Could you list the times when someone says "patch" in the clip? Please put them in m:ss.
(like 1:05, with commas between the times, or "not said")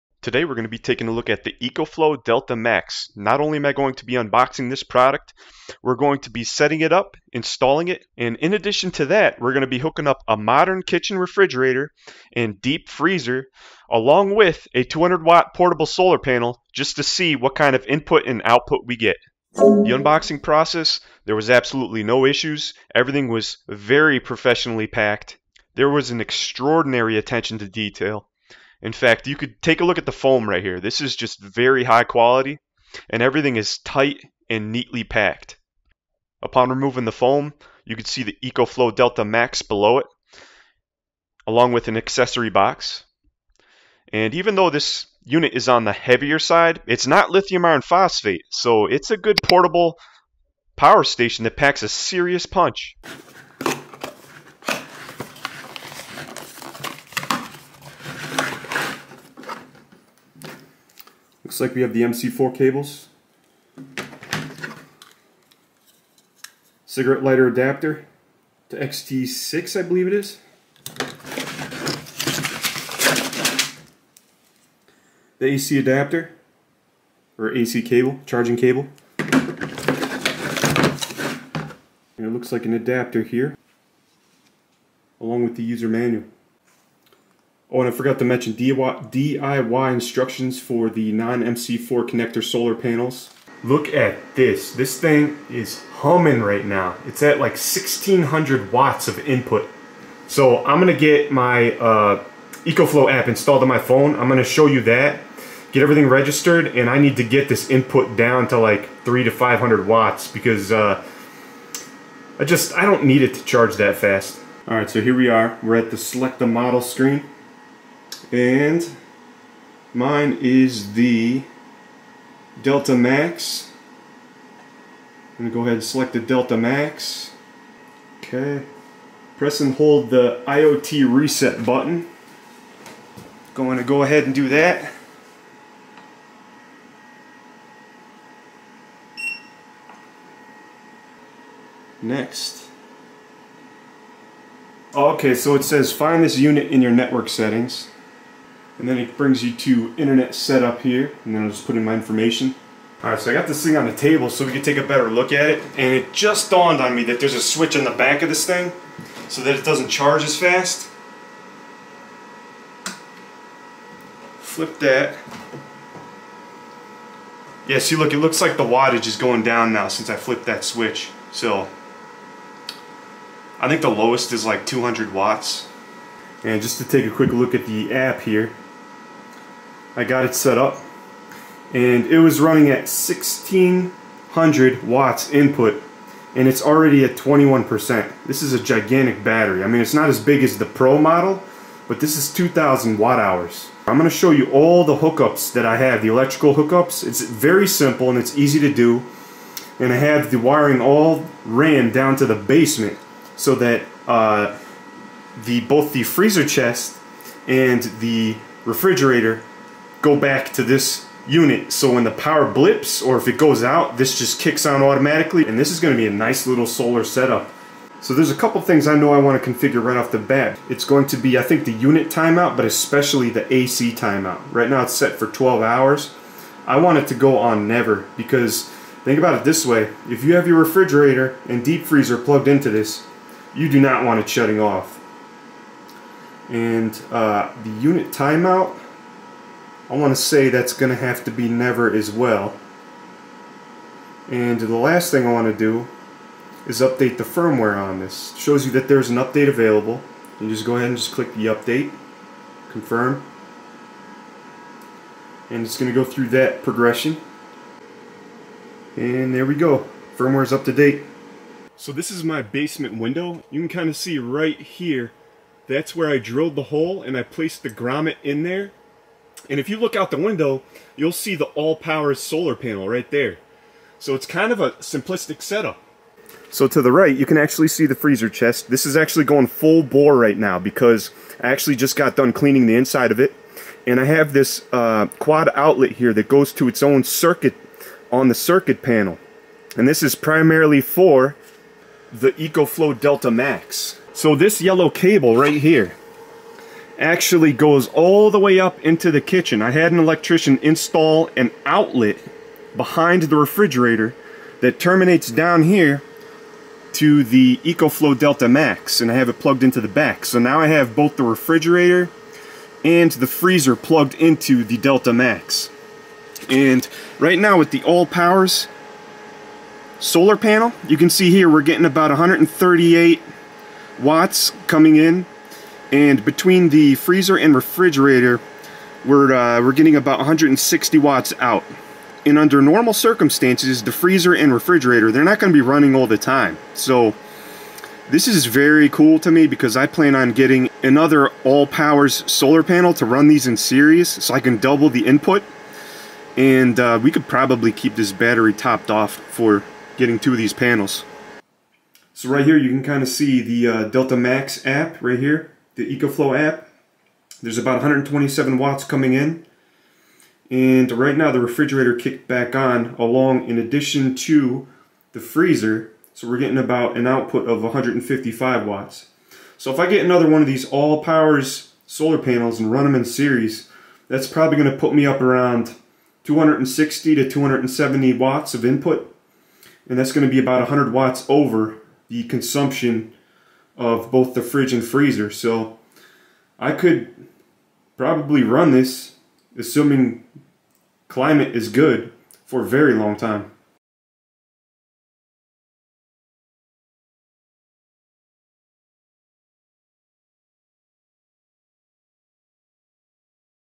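not said.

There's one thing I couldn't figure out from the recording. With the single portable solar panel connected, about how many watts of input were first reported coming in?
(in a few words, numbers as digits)
138 watts.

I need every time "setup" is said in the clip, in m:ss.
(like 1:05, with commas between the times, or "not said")
2:30, 3:37, 4:35.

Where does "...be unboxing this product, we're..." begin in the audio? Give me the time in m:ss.
0:04.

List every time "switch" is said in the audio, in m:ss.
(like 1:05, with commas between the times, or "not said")
2:37, 2:50.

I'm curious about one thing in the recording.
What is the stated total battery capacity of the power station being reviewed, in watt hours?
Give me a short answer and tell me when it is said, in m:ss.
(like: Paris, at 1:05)
2000 watt hours, at 3:12.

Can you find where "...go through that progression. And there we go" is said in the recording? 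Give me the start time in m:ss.
4:15.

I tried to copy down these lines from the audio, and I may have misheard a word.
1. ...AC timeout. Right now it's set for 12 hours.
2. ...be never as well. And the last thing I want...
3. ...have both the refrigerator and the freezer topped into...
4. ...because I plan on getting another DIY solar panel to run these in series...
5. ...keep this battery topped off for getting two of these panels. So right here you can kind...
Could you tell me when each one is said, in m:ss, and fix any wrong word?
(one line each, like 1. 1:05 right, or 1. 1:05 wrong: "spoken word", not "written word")
1. 3:43 right
2. 4:01 right
3. 5:10 wrong: "plugged", not "topped"
4. 5:39 wrong: "Allpowers", not "DIY"
5. 5:47 right.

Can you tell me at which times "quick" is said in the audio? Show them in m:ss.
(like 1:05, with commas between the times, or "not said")
2:57.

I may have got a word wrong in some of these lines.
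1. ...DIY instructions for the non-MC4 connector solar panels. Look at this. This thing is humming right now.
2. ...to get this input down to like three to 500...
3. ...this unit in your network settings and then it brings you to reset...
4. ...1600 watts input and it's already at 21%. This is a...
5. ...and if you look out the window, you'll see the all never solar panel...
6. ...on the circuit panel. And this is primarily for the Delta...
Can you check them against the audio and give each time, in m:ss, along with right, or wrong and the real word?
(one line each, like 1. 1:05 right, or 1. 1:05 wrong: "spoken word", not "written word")
1. 1:28 right
2. 1:47 right
3. 2:26 wrong: "internet", not "reset"
4. 3:02 right
5. 4:29 wrong: "power", not "never"
6. 4:48 wrong: "EcoFlow", not "Delta".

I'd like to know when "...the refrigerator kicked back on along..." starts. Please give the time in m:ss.
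6:01.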